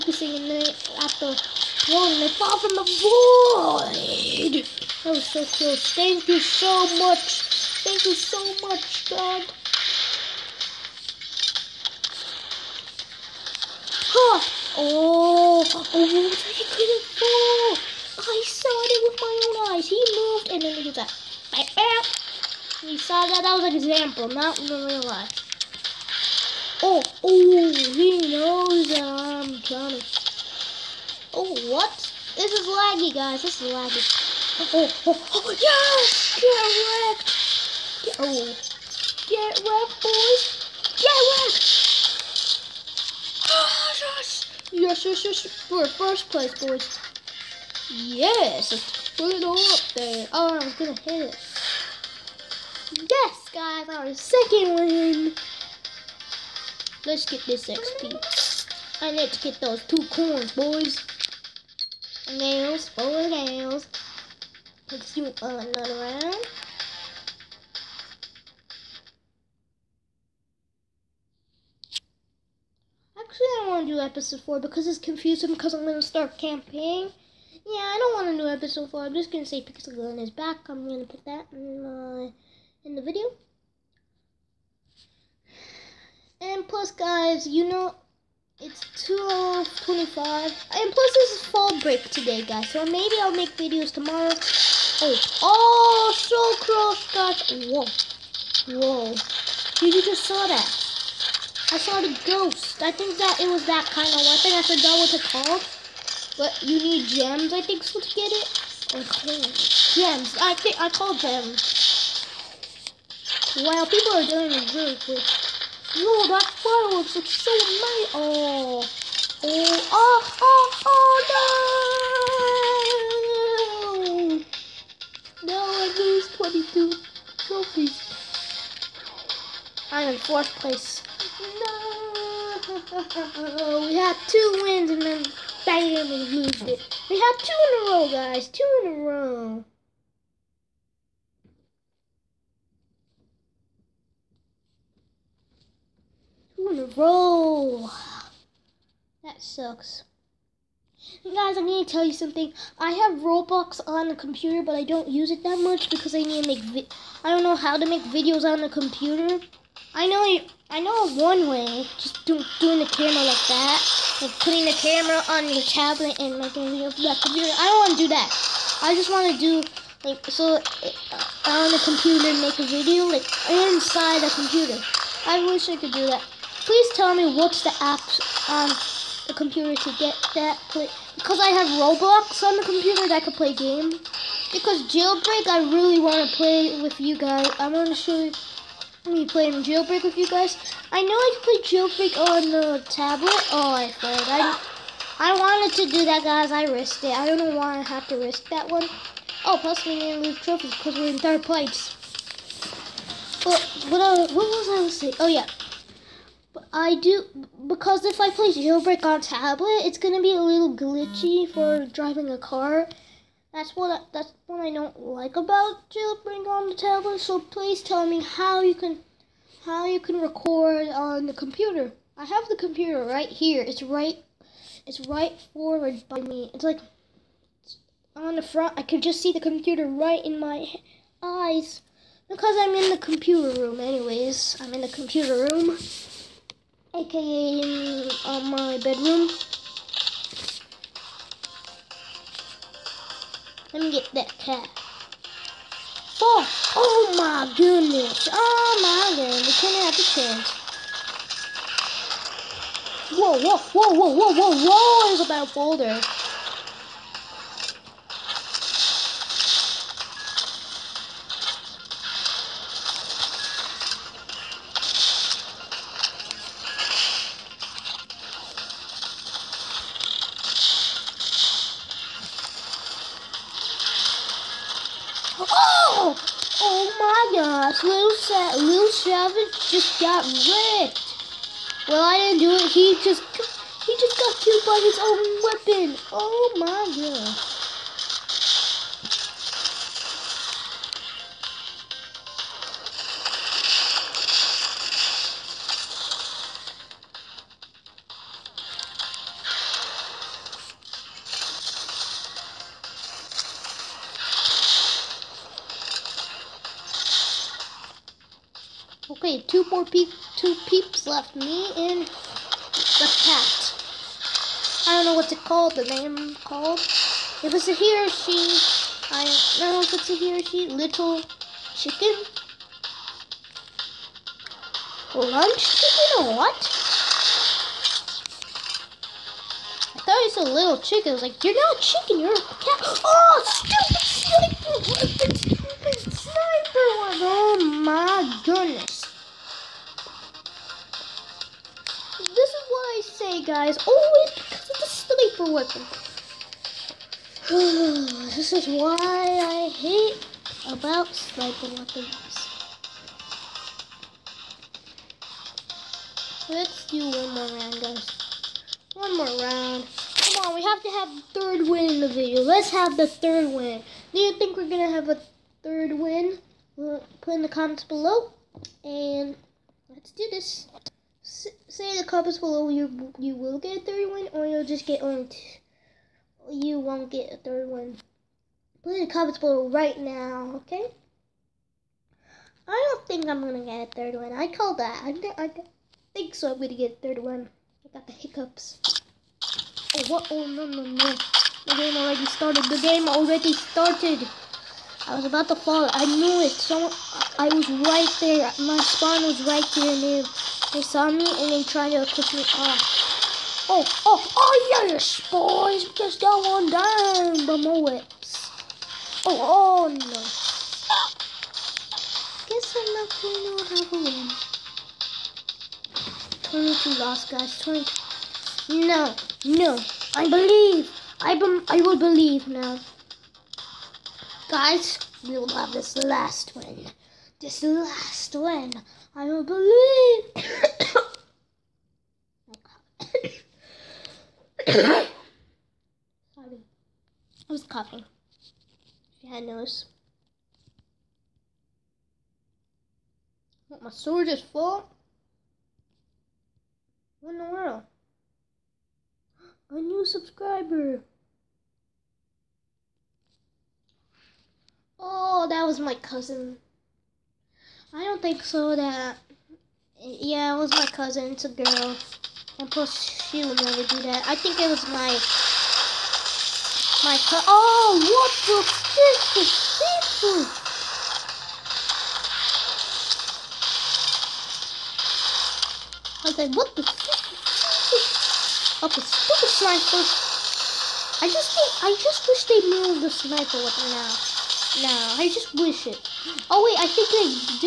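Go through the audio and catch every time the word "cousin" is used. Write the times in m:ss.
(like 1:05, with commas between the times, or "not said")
7:35, 7:40.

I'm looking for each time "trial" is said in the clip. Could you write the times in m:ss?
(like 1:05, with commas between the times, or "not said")
not said.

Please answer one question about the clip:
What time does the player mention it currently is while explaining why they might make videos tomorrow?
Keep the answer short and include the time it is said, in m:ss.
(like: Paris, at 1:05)
2:25, at 1:29.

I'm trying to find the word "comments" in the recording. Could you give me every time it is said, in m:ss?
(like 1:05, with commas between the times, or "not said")
6:07, 6:19.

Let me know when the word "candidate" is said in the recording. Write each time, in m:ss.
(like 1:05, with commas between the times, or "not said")
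not said.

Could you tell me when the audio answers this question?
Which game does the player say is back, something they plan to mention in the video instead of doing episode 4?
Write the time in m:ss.
1:19.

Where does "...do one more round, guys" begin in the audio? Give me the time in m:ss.
5:56.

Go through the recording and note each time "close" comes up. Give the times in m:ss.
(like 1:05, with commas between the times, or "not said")
0:05, 1:36.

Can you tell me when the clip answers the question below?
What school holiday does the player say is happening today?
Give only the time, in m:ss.
1:31.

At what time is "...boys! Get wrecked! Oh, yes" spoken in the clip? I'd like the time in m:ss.
0:40.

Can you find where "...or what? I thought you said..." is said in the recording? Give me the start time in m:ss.
5:26.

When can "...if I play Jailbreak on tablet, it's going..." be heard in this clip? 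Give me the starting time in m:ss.
3:28.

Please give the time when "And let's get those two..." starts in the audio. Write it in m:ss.
0:59.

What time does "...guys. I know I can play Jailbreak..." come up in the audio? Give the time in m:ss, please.
3:10.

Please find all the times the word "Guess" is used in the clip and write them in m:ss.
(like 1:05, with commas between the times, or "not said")
6:52.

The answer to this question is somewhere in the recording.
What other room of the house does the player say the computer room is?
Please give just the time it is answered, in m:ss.
3:58.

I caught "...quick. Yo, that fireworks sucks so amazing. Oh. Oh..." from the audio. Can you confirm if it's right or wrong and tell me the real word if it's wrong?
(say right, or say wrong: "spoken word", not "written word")
wrong: "looks", not "sucks".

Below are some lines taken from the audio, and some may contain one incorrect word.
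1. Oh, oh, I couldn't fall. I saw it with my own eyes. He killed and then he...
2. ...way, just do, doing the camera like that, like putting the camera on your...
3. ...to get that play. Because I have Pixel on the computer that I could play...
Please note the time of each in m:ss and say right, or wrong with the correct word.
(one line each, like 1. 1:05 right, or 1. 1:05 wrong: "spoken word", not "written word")
1. 0:14 wrong: "moved", not "killed"
2. 2:41 right
3. 2:59 wrong: "Roblox", not "Pixel".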